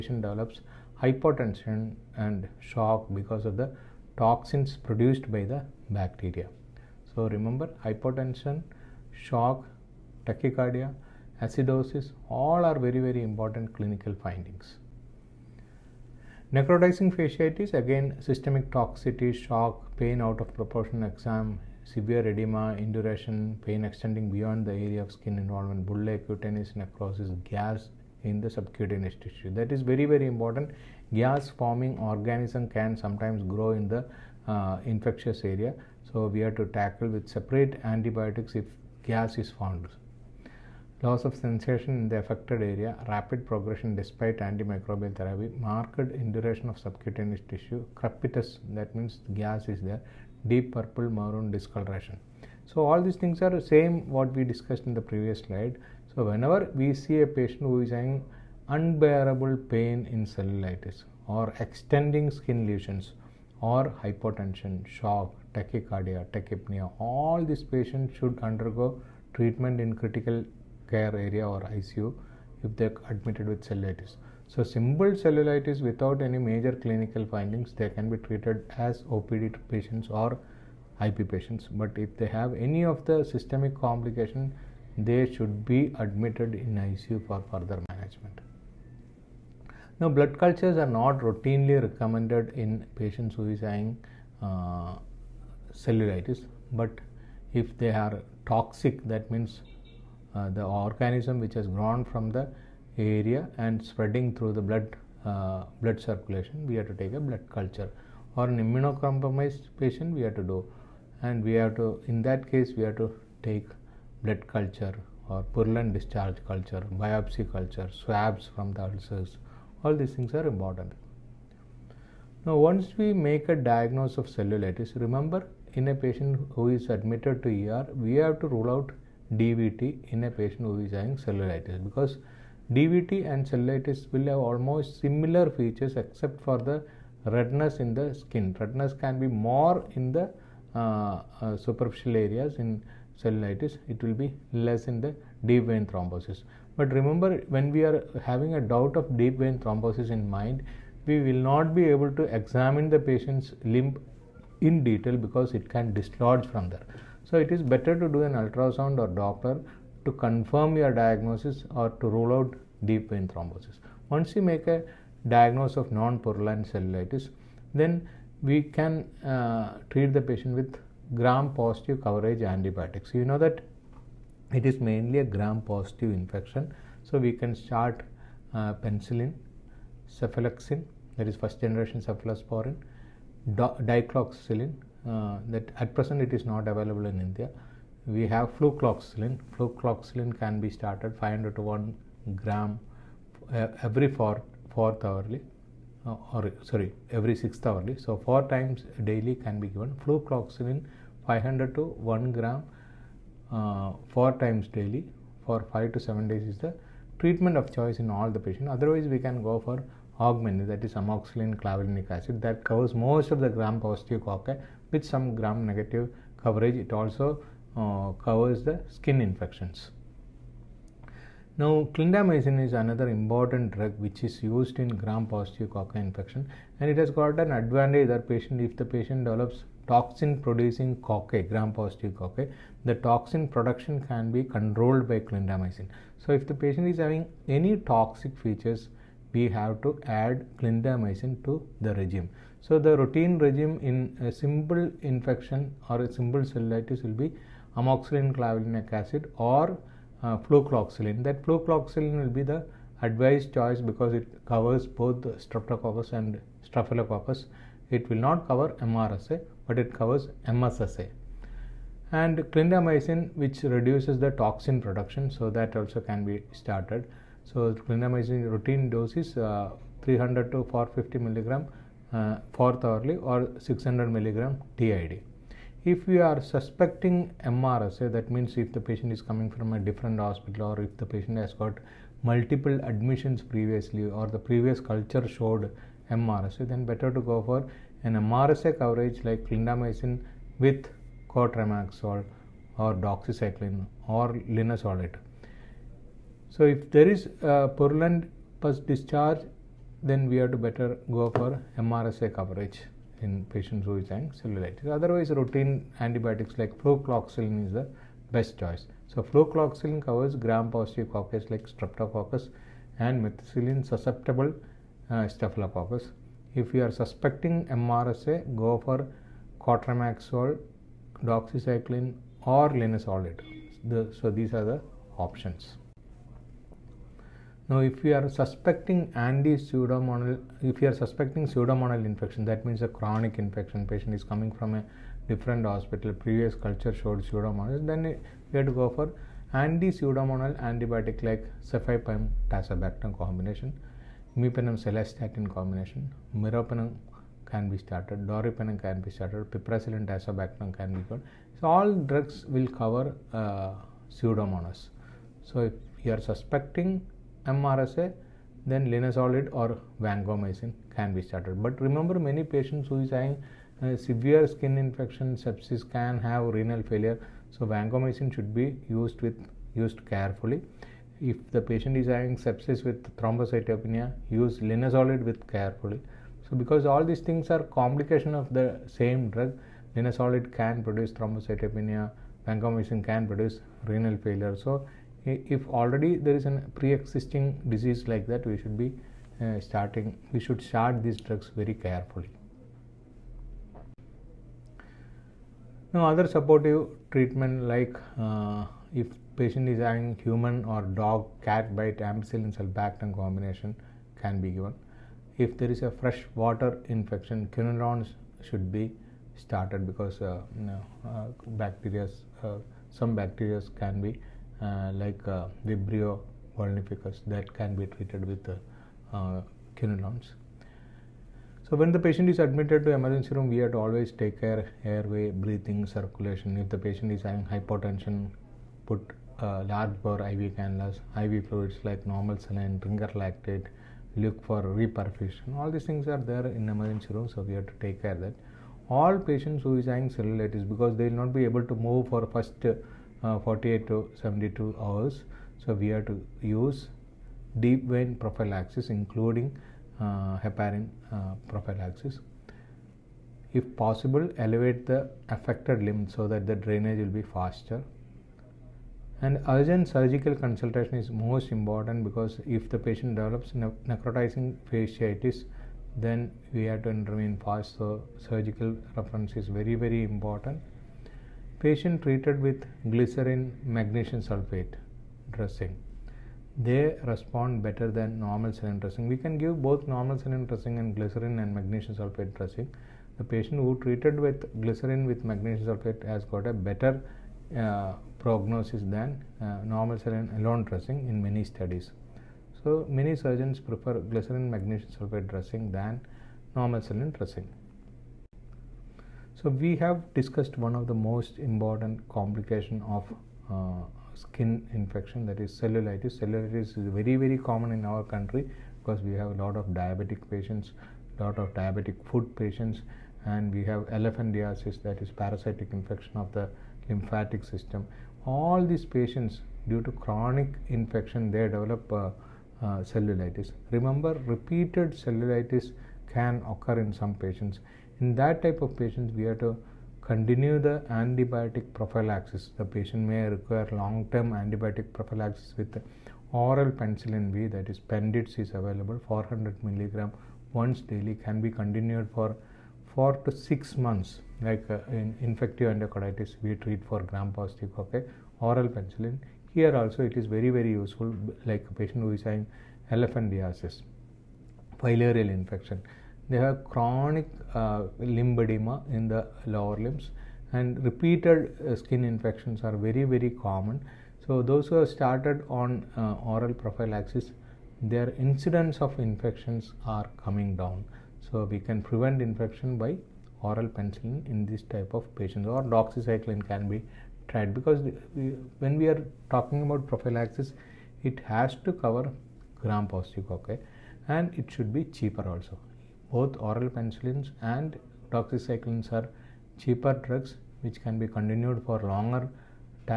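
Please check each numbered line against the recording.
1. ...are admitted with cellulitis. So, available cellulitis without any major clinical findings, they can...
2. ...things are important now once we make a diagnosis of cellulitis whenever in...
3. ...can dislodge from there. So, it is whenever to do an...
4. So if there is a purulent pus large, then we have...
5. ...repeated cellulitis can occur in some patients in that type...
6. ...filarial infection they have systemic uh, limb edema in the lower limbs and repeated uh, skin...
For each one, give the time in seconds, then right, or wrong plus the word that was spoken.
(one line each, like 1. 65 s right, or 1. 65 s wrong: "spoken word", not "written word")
1. 72 s wrong: "simple", not "available"
2. 120 s wrong: "remember", not "whenever"
3. 155 s wrong: "better", not "whenever"
4. 296 s wrong: "discharge", not "large"
5. 524 s right
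6. 554 s wrong: "chronic", not "systemic".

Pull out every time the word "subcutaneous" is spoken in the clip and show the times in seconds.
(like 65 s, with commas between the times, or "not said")
28 s, 46 s.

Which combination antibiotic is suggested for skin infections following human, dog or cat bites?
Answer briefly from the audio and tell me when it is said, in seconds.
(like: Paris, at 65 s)
Ampicillin sulbactam, at 401 s.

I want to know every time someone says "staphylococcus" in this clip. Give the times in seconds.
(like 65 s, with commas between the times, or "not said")
256 s, 315 s.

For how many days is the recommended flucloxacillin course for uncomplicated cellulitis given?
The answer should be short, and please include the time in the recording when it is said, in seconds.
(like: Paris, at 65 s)
5 to 7 days, at 205 s.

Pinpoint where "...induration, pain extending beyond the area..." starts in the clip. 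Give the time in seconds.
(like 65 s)
22 s.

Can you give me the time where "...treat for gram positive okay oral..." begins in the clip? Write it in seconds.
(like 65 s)
546 s.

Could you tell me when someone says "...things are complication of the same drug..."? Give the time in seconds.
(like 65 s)
377 s.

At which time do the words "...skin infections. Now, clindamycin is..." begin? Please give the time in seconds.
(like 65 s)
218 s.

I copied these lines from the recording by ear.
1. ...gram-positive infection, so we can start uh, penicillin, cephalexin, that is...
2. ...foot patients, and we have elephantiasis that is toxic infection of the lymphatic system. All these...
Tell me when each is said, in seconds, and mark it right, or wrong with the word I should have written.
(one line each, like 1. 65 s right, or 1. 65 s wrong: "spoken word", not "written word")
1. 175 s right
2. 512 s wrong: "parasitic", not "toxic".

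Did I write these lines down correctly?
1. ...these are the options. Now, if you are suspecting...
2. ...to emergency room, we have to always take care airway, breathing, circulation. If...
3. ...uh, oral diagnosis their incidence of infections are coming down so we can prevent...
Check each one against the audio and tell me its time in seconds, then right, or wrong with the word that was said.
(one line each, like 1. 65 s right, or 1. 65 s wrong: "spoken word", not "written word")
1. 324 s right
2. 422 s right
3. 565 s wrong: "prophylaxis", not "diagnosis".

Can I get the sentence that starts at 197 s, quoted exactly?
So four times daily can be given.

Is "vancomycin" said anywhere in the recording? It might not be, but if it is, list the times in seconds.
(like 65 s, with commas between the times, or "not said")
360 s, 367 s, 382 s.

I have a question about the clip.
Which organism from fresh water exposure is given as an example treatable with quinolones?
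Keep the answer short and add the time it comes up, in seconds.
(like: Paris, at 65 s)
Vibrio vulnificus, at 415 s.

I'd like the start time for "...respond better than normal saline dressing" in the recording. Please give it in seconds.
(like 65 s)
477 s.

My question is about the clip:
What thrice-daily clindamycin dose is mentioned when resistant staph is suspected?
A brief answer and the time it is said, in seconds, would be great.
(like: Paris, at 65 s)
600 milligram, at 273 s.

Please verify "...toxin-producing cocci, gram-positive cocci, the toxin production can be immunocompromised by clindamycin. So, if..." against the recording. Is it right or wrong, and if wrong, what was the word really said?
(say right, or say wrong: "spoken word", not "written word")
wrong: "controlled", not "immunocompromised".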